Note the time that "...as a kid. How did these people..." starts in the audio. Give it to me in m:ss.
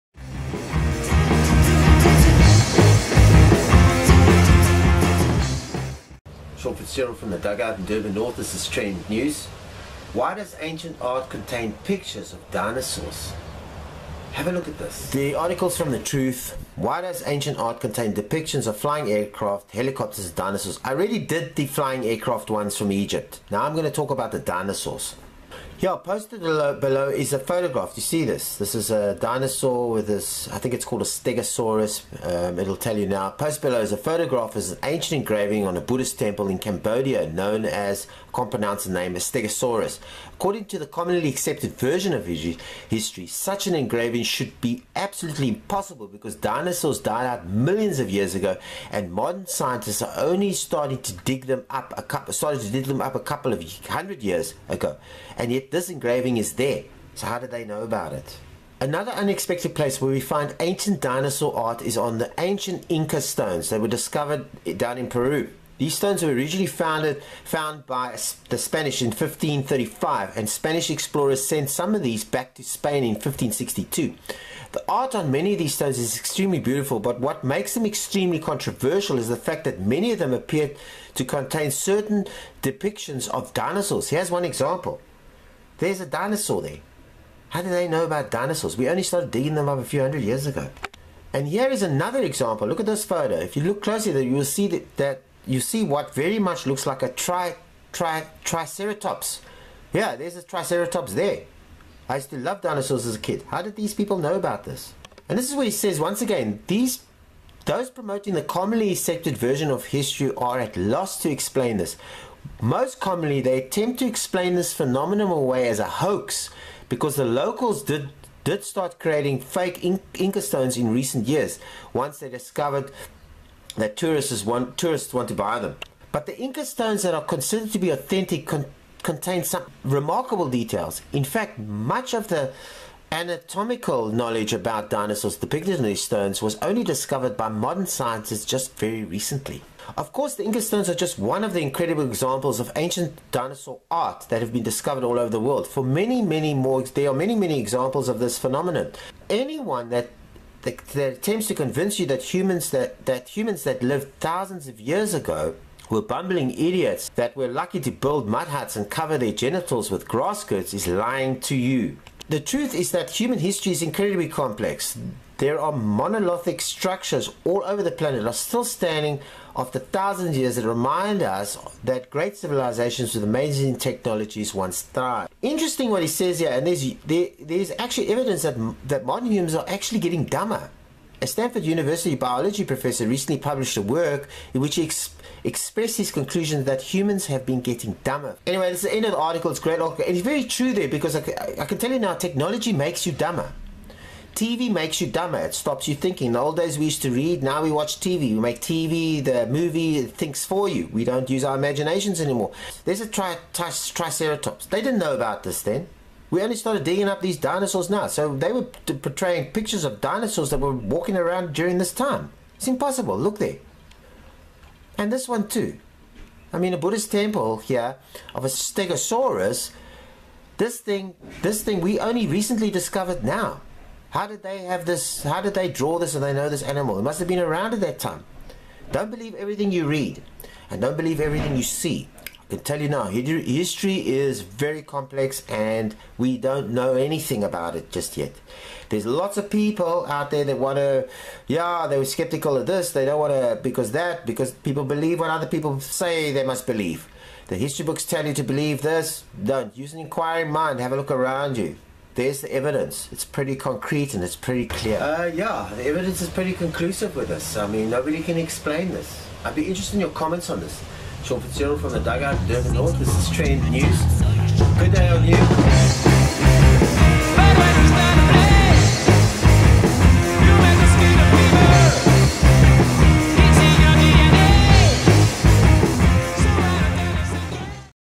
1:43.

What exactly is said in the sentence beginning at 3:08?
Anyway, this is the end of the article.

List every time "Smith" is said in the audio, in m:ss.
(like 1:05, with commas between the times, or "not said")
not said.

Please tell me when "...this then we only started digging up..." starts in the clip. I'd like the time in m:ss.
3:25.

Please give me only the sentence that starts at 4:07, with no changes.
The history books tell you to believe this, don't.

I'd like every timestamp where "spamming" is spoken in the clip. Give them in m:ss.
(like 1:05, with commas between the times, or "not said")
not said.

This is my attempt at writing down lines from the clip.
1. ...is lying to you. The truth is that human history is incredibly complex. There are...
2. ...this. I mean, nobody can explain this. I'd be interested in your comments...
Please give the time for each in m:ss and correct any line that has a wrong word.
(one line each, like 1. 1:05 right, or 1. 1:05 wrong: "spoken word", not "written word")
1. 2:40 right
2. 4:17 right.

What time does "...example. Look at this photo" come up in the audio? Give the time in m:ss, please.
1:32.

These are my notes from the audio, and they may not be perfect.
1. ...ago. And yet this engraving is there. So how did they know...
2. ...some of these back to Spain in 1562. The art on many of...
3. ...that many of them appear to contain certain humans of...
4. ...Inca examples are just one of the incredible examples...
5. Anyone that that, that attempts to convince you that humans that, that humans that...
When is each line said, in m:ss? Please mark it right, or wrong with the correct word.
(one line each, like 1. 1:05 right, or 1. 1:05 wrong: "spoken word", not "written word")
1. 0:54 right
2. 1:11 right
3. 1:19 wrong: "depictions", not "humans"
4. 2:20 wrong: "stones", not "examples"
5. 2:29 right.